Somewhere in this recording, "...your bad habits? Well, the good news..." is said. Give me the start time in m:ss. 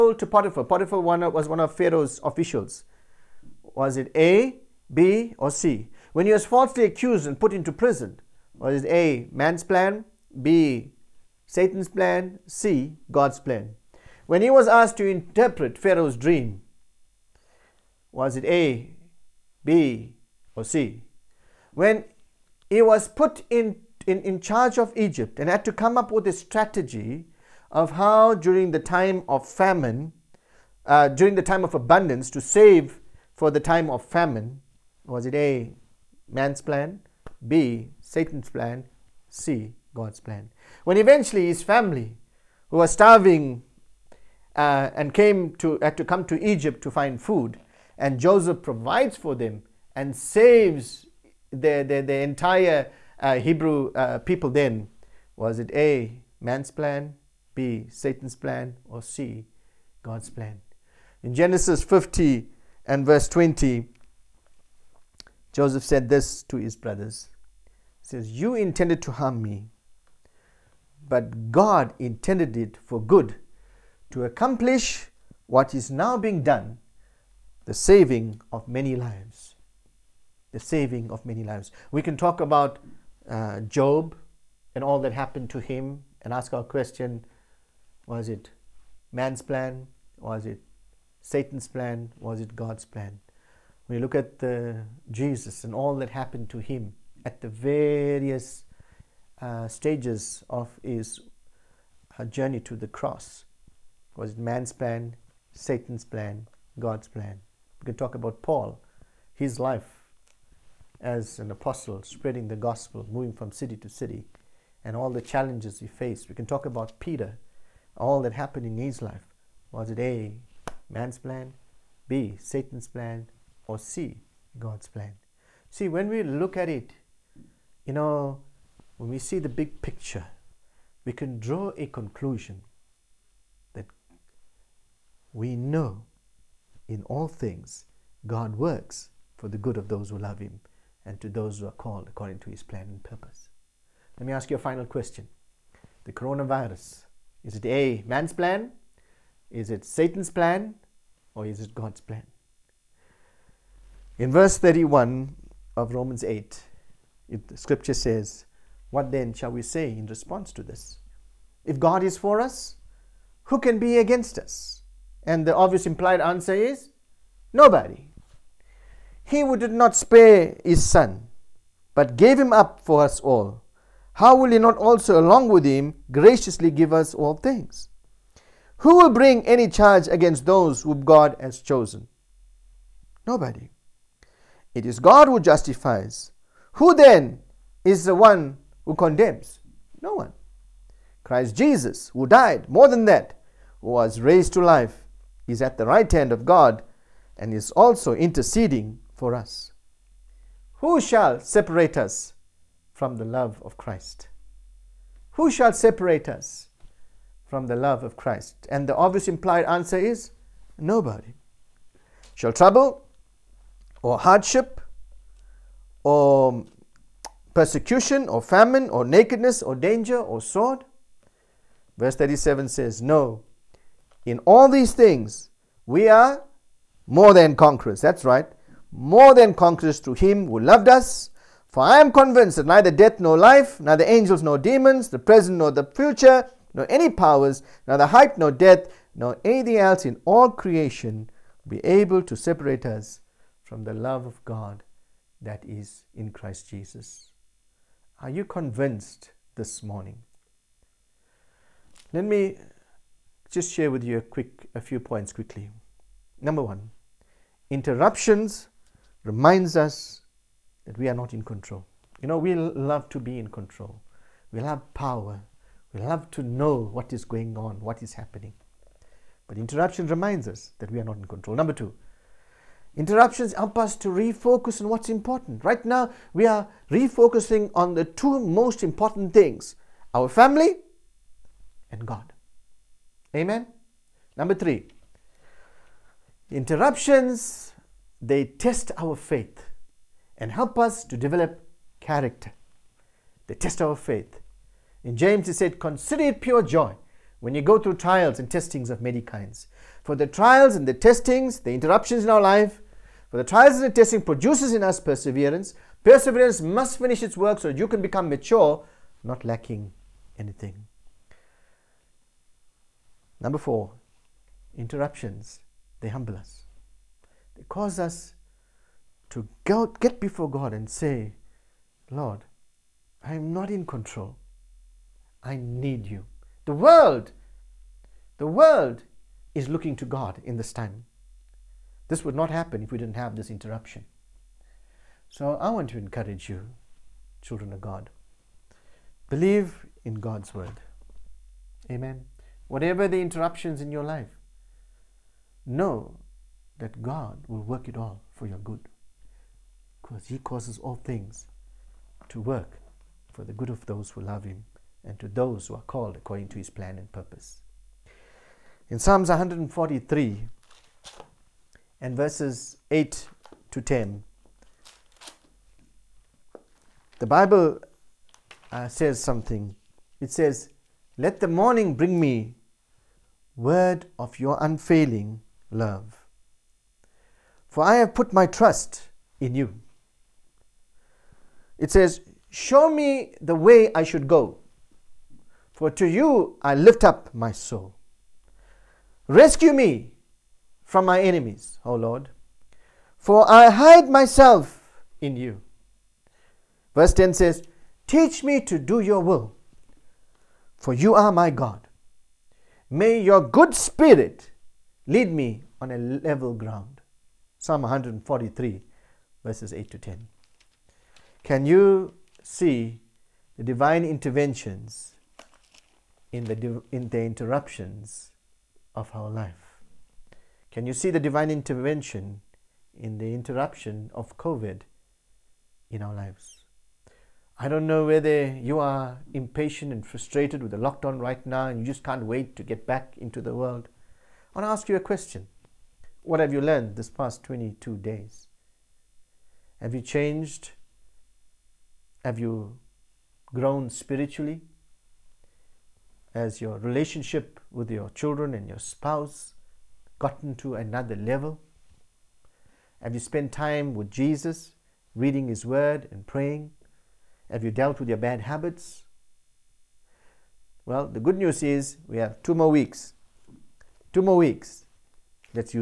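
7:38.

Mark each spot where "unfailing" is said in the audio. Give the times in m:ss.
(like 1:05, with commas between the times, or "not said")
6:14.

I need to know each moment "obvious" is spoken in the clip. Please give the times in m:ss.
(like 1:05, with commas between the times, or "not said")
2:45, 3:28.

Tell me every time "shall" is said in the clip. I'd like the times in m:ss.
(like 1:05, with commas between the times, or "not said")
2:39, 3:20, 3:25, 3:32.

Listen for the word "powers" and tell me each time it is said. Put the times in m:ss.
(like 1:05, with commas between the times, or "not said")
3:57, 4:24.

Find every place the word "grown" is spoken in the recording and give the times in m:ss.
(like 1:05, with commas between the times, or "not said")
7:23.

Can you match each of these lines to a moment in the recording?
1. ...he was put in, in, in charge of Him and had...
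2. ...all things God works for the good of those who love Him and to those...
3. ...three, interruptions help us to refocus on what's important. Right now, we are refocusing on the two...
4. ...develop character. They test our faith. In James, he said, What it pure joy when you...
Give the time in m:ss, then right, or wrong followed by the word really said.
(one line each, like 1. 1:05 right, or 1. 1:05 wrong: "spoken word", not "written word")
1. 0:22 wrong: "Egypt", not "Him"
2. 2:17 right
3. 4:31 wrong: "two", not "three"
4. 4:51 wrong: "Consider", not "What".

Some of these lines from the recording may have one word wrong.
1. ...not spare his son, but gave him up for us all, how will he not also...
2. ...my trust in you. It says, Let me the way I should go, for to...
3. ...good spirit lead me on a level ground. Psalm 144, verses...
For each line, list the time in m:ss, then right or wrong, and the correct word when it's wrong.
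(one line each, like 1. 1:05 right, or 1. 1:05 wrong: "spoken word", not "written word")
1. 2:49 right
2. 6:18 wrong: "Show", not "Let"
3. 6:43 wrong: "143", not "144".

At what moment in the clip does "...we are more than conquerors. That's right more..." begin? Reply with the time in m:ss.
3:45.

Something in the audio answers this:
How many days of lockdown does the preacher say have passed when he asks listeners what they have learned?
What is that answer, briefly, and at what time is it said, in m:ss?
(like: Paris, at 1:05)
22, at 7:17.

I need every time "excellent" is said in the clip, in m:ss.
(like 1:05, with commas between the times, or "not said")
not said.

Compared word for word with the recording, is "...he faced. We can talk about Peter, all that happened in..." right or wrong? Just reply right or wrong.
right.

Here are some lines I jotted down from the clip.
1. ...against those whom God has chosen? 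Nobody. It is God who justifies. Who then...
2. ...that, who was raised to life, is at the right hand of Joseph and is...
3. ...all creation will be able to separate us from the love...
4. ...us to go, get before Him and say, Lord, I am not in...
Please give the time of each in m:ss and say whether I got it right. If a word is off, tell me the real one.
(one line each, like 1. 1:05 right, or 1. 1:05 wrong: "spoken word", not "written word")
1. 3:00 right
2. 3:13 wrong: "God", not "Joseph"
3. 4:00 right
4. 5:17 wrong: "God", not "Him".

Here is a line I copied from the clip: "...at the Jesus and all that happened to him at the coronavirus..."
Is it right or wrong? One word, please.
wrong.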